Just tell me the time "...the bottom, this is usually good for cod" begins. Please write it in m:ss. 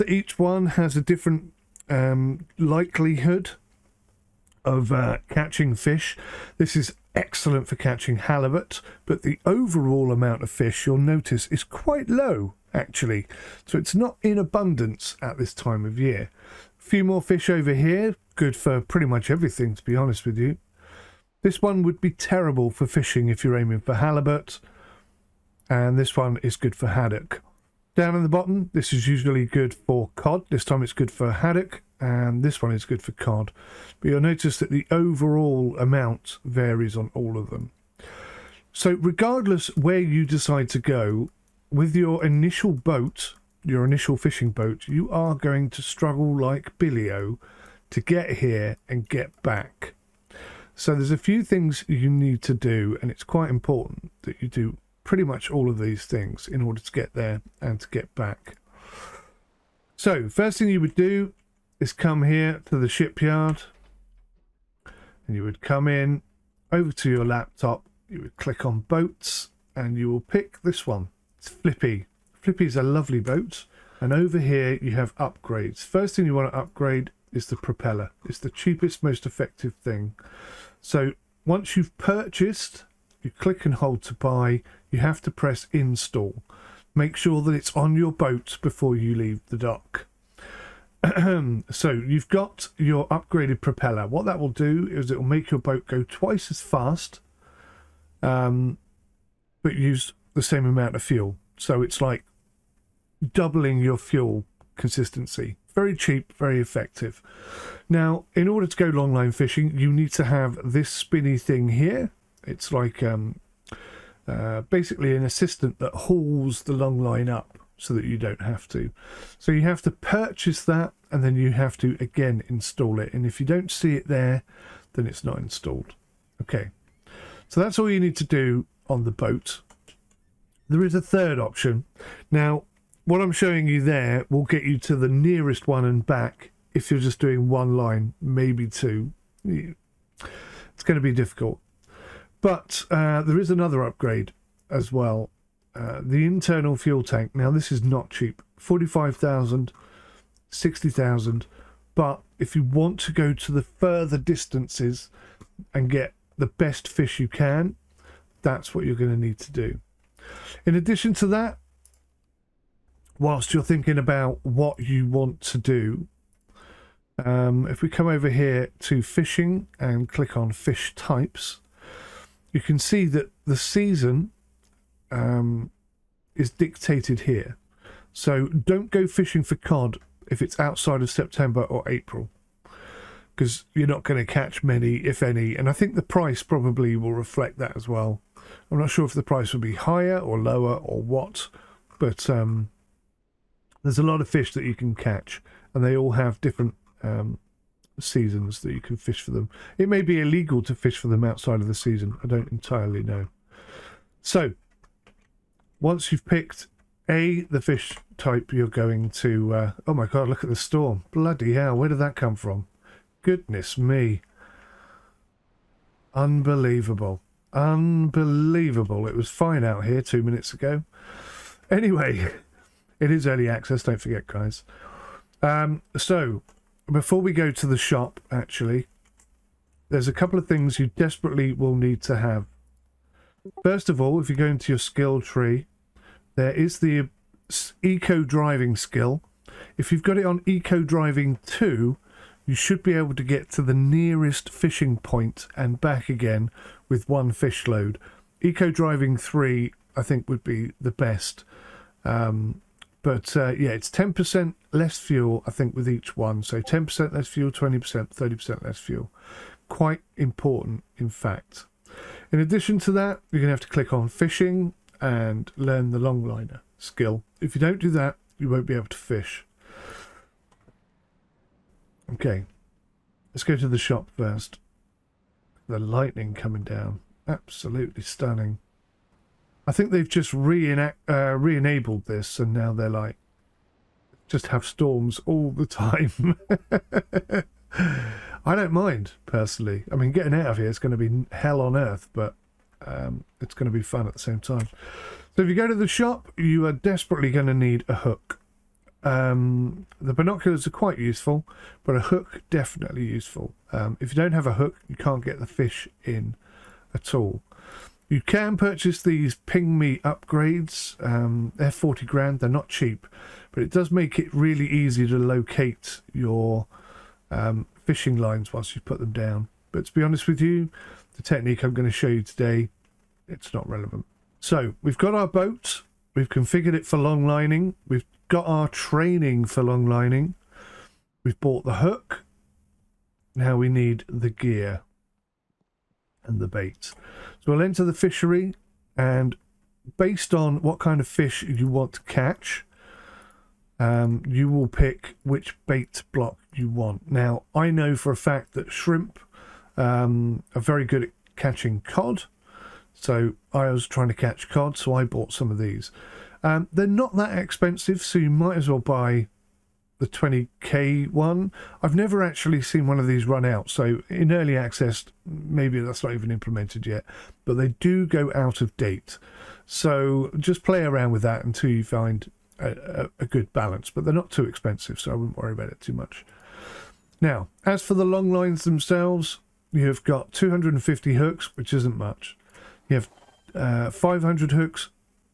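0:28.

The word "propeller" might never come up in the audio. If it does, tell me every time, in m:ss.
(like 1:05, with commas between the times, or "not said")
1:17, 1:33.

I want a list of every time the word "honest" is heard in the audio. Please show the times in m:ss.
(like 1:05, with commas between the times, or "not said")
0:19, 5:20.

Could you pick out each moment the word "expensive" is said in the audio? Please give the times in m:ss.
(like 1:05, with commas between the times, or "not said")
5:57, 6:14.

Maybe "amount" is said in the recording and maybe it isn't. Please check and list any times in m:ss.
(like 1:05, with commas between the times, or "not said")
0:10, 0:35, 1:40.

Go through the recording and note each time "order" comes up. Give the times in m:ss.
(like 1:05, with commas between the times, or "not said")
0:56, 1:48.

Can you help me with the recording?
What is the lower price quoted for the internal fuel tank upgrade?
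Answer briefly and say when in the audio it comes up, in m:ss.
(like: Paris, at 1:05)
45,000, at 2:28.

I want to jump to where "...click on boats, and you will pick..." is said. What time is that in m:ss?
1:08.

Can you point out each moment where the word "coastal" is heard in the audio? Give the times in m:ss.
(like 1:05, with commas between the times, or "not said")
not said.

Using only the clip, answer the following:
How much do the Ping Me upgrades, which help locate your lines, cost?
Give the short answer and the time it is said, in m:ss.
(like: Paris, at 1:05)
40 grand, at 5:11.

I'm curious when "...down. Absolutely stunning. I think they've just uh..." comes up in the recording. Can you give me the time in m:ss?
4:36.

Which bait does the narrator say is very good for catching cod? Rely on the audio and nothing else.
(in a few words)
Shrimp.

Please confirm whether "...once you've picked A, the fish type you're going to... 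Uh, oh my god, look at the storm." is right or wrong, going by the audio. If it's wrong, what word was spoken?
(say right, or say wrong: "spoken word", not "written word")
right.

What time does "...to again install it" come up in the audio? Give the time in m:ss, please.
2:01.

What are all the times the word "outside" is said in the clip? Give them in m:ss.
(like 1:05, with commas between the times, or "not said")
3:00, 3:21.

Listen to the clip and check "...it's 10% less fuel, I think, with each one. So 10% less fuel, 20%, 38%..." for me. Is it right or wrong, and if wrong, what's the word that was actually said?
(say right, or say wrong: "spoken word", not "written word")
wrong: "30", not "38".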